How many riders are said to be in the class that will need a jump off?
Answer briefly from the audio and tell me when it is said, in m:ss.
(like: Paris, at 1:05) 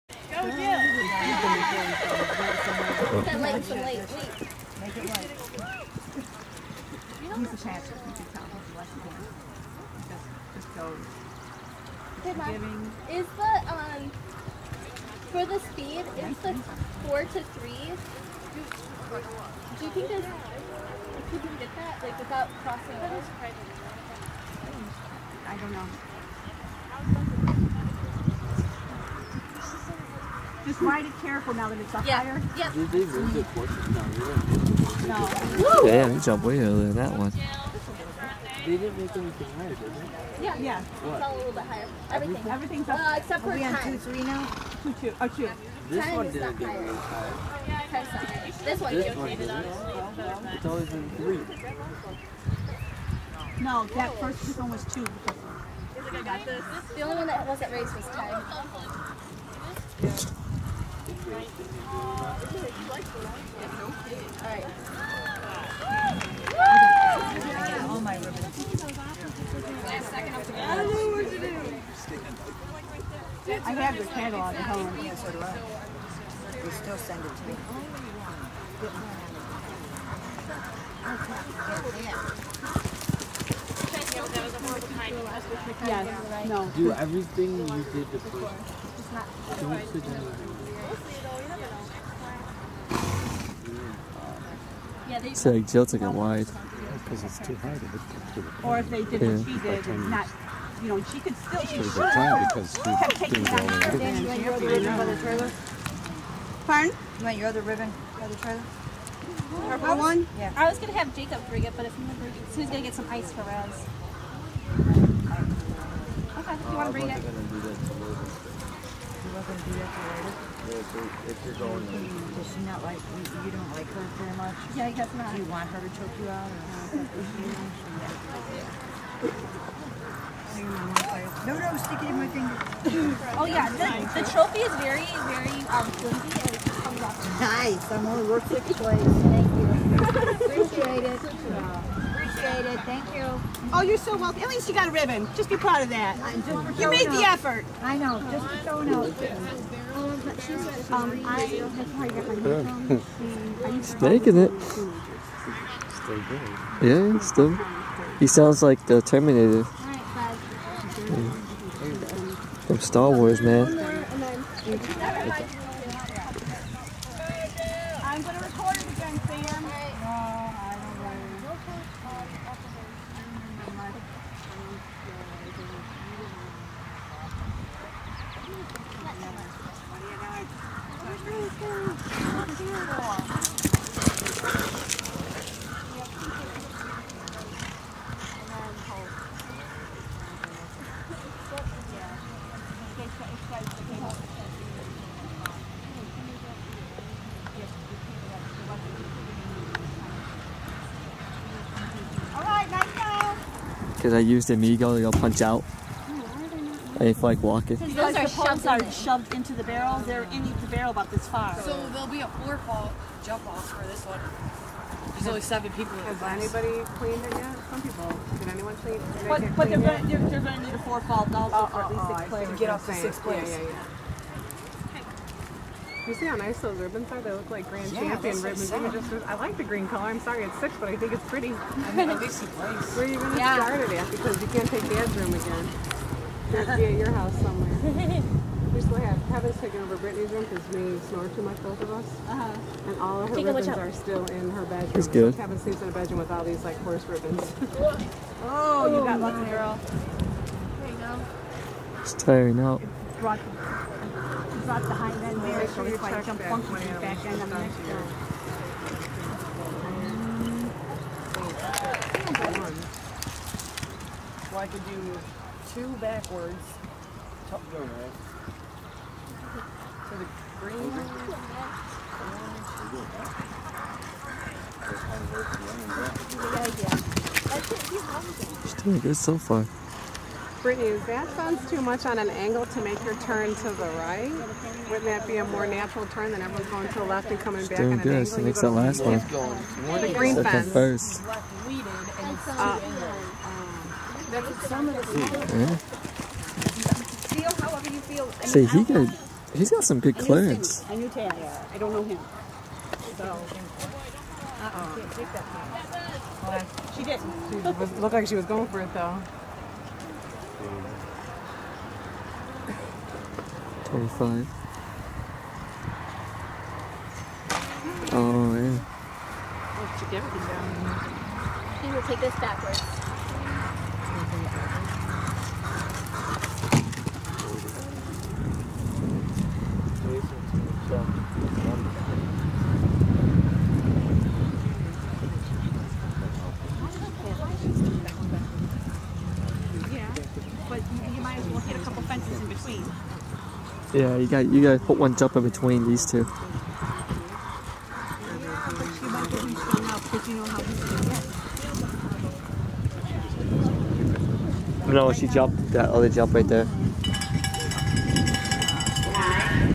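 7, at 3:35.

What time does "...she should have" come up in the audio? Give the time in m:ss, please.
1:41.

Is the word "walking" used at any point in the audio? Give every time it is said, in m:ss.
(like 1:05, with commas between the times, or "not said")
3:27.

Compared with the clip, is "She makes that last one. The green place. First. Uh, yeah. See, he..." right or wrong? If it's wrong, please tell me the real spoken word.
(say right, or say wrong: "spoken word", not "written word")
wrong: "fence", not "place".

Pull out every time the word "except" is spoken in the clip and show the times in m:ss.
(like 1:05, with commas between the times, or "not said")
0:43.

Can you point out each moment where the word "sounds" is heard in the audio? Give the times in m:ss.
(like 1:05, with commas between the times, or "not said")
2:38, 4:41.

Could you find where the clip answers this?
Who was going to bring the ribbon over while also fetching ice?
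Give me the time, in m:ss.
1:51.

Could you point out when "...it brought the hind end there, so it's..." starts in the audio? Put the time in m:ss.
4:13.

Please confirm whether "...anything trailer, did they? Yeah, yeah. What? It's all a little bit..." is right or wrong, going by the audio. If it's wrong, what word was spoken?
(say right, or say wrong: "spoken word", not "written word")
wrong: "higher", not "trailer".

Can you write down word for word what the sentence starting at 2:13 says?
oh yeah, the, the trophy is very, very um, flimsy Nice, I'm only worth work six ways.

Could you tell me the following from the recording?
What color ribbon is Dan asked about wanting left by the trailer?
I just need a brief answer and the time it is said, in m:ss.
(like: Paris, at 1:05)
Purple, at 1:49.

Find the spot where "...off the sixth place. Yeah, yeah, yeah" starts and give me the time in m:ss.
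3:42.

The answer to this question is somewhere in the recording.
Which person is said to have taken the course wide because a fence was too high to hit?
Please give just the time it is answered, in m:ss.
1:35.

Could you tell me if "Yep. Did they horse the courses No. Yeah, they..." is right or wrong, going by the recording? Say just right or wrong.
wrong.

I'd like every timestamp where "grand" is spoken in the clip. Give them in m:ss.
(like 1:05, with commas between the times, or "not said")
3:47.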